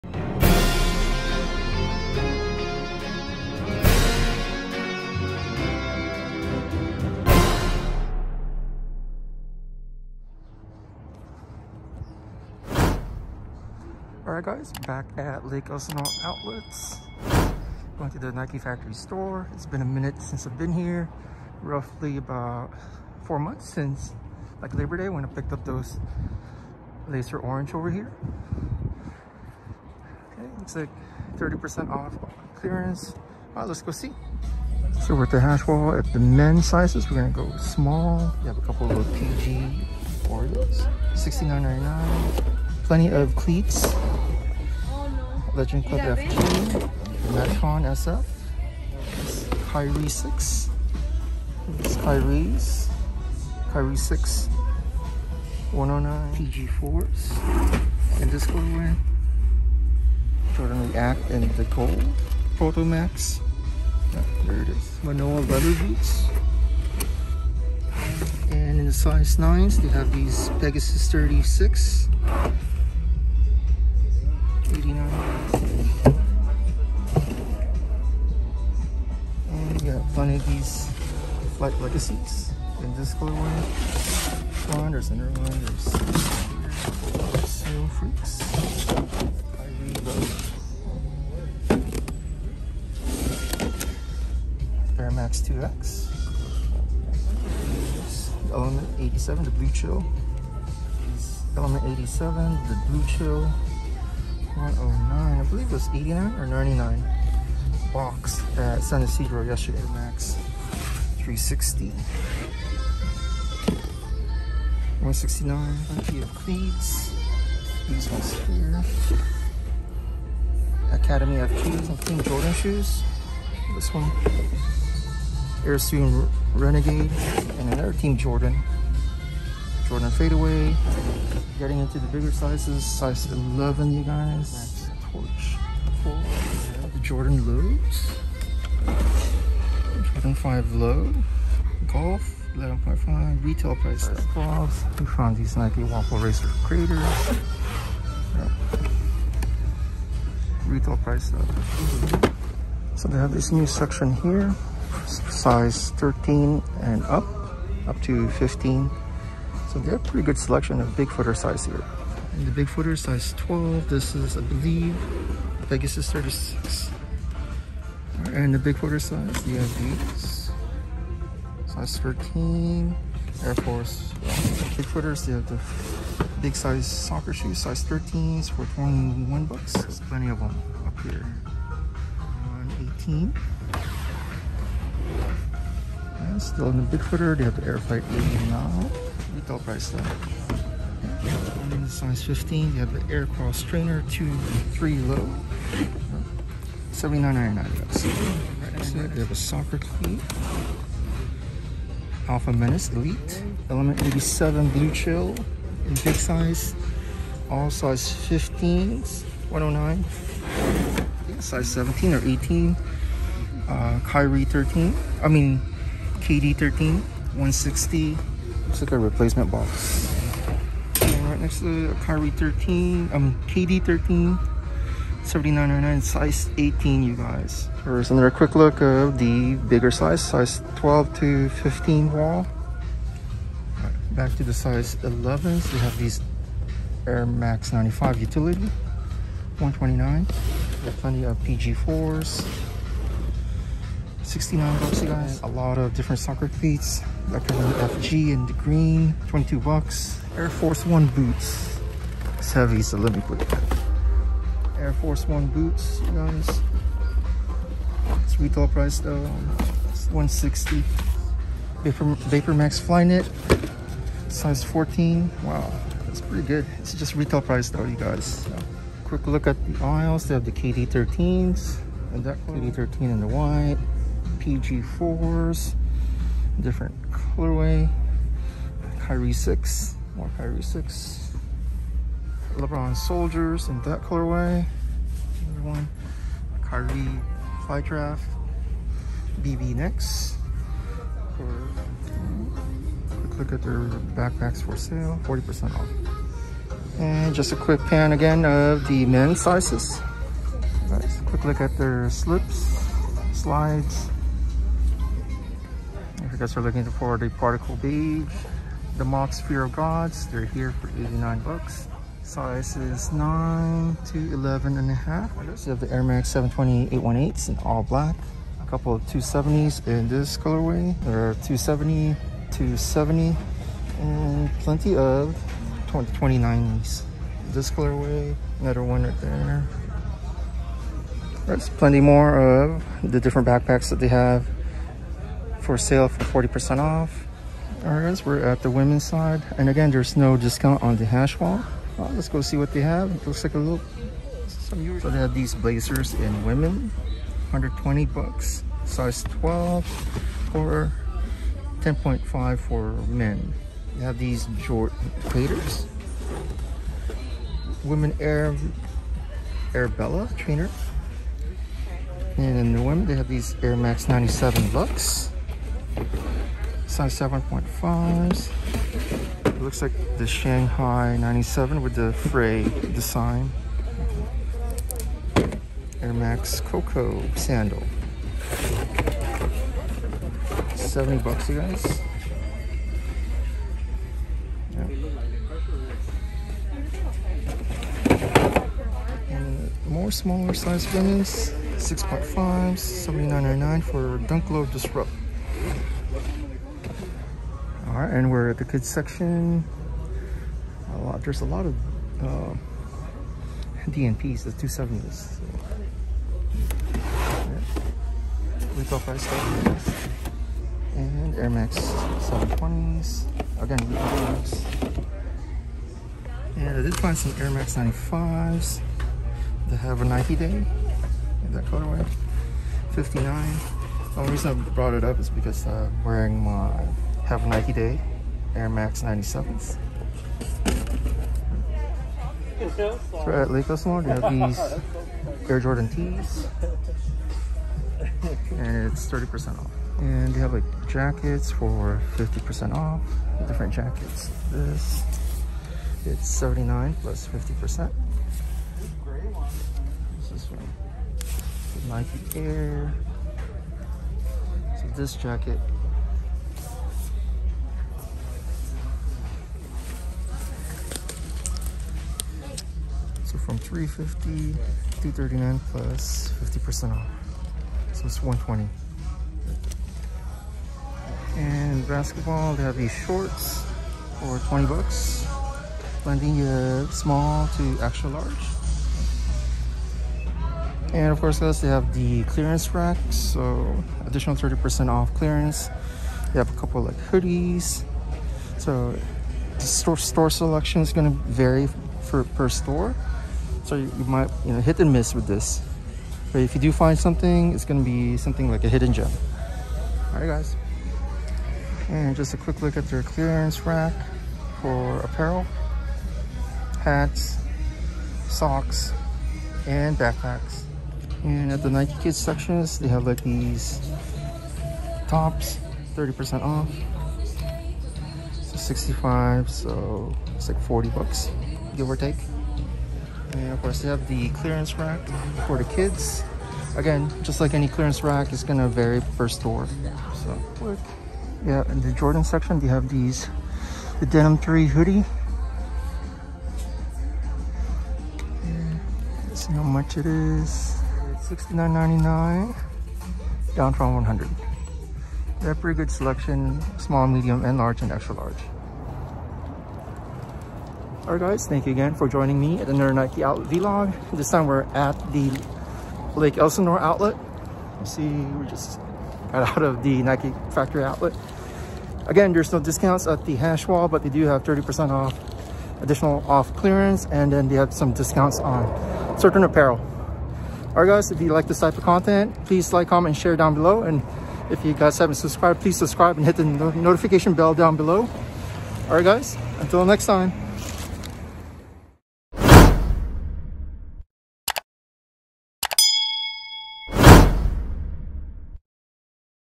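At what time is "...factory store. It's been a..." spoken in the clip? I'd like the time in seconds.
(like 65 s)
18 s.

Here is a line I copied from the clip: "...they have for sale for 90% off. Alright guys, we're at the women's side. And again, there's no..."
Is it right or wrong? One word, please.
wrong.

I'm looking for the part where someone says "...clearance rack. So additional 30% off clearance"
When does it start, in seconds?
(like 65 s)
482 s.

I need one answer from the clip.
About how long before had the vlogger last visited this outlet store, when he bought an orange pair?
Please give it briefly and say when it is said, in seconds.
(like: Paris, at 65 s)
4 months, at 23 s.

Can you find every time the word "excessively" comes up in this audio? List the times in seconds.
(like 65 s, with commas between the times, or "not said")
not said.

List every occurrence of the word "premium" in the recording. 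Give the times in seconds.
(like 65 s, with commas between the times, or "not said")
not said.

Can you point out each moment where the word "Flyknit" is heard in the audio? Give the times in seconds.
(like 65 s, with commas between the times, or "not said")
262 s.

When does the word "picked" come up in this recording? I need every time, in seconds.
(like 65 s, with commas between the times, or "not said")
25 s.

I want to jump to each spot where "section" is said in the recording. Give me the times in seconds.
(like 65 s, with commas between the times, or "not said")
153 s, 398 s, 512 s, 532 s.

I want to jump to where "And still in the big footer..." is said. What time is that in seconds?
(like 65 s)
186 s.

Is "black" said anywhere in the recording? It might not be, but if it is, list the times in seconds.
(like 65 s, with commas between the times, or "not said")
317 s.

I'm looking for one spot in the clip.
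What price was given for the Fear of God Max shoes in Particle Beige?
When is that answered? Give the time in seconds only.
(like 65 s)
310 s.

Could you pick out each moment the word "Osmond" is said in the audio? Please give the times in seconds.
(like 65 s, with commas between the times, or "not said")
433 s.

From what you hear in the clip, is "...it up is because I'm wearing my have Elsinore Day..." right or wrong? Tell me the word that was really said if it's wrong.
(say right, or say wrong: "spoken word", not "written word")
wrong: "Nike", not "Elsinore".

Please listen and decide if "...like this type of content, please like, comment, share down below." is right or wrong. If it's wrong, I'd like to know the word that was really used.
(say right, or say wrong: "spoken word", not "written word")
right.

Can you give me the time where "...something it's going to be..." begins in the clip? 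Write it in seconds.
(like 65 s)
496 s.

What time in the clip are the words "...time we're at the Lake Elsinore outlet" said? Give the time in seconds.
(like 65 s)
554 s.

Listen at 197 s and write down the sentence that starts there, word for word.
dollars Right next to it, have a soccer cleat.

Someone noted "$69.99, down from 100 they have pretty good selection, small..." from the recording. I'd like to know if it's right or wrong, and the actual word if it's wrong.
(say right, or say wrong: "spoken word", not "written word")
right.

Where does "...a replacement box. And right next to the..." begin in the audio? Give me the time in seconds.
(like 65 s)
218 s.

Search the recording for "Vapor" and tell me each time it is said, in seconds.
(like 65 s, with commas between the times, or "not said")
261 s.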